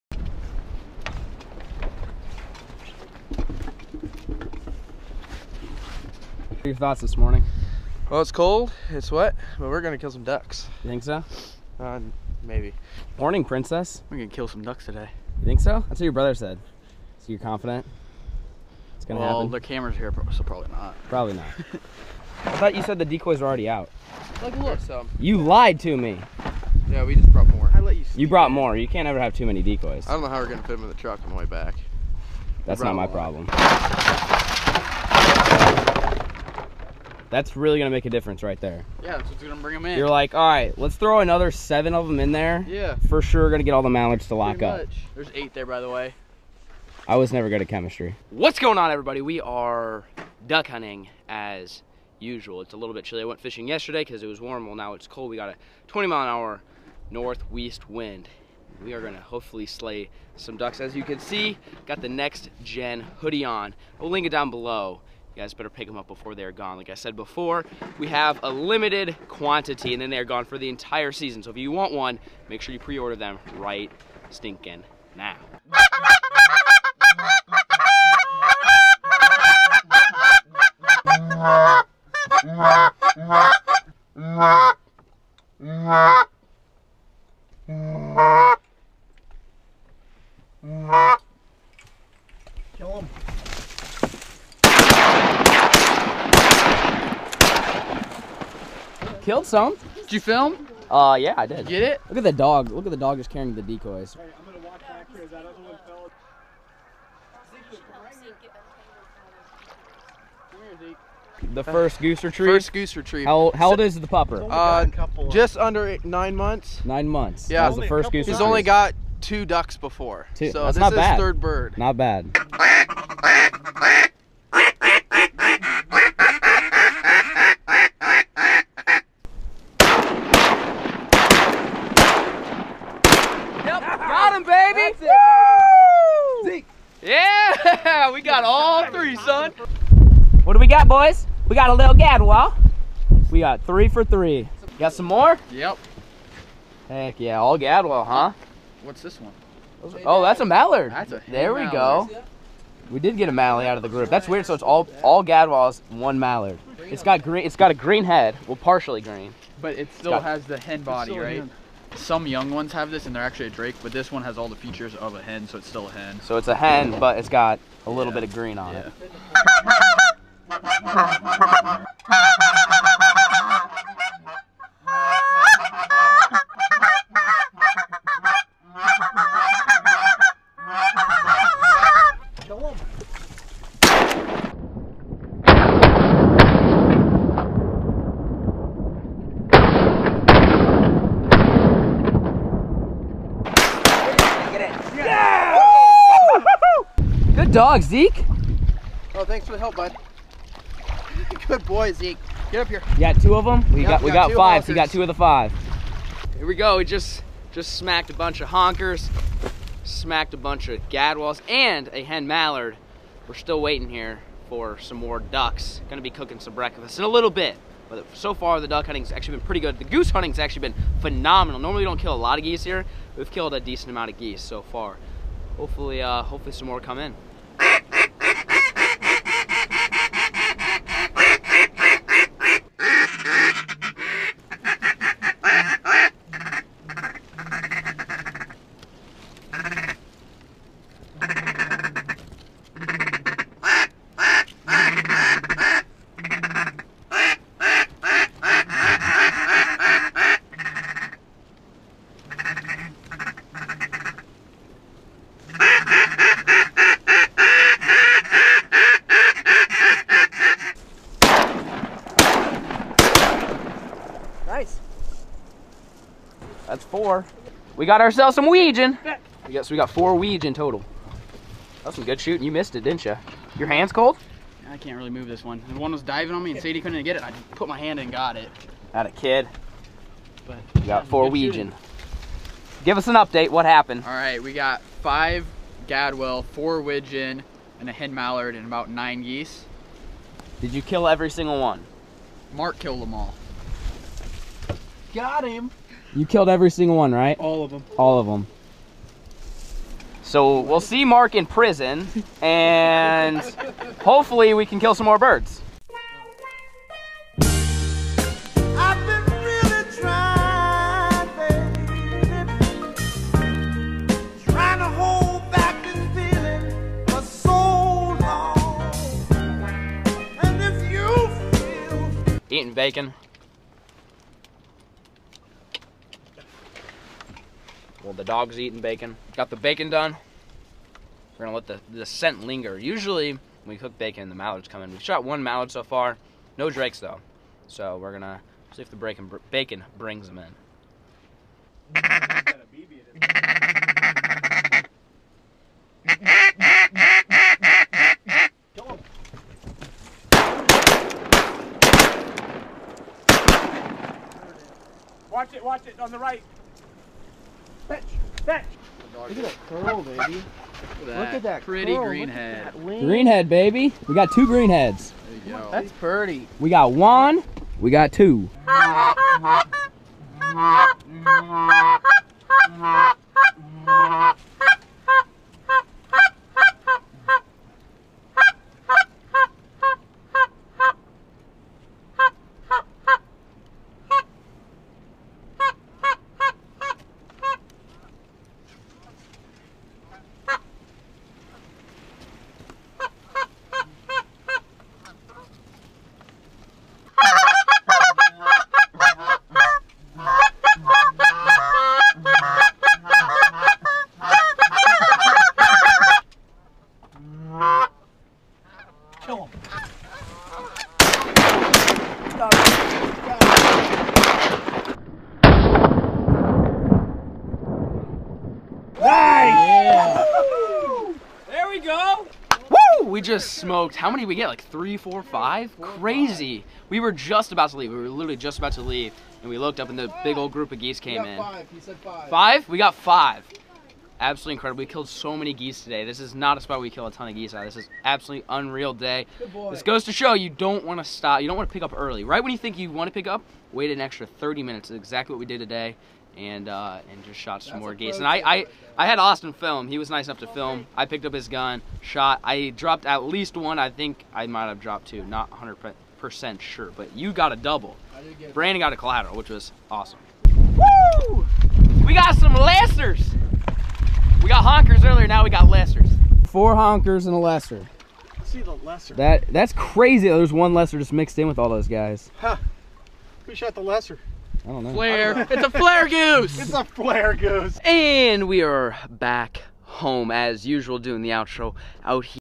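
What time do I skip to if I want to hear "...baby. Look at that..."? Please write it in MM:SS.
06:00.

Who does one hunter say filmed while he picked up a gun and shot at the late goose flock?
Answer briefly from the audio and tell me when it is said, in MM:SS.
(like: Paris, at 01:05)
Austin, at 07:29.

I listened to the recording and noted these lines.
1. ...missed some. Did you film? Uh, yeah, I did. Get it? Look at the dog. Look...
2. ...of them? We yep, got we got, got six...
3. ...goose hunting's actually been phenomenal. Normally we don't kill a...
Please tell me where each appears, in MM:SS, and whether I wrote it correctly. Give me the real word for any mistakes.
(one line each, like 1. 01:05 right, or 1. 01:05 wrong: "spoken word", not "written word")
1. 01:39 wrong: "killed", not "missed"
2. 03:23 wrong: "five", not "six"
3. 03:39 right.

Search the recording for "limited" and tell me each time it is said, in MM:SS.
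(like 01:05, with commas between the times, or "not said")
01:08.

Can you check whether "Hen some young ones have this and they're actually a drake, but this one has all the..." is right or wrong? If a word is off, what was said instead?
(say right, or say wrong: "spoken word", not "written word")
right.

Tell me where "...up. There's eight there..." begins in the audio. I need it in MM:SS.
00:44.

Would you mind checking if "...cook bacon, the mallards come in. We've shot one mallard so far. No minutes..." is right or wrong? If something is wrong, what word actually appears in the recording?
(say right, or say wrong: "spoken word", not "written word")
wrong: "drakes", not "minutes".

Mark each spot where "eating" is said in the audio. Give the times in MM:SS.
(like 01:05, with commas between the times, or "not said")
05:22, 05:28.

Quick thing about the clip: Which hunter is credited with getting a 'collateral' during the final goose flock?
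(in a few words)
Brandon.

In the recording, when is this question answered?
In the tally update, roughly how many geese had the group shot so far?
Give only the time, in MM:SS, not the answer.
04:48.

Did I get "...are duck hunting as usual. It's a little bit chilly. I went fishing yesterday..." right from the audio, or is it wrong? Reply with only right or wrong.
right.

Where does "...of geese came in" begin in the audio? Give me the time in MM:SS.
07:10.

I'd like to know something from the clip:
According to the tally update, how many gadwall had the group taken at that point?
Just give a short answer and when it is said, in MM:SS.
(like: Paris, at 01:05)
5, at 04:45.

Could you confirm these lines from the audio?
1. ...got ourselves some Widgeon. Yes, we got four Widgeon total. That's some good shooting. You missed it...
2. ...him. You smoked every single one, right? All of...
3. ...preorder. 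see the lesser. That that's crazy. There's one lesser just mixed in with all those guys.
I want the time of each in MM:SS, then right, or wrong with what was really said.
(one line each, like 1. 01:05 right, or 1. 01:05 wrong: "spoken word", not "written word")
1. 04:27 right
2. 04:55 wrong: "killed", not "smoked"
3. 07:47 wrong: "lesser", not "preorder".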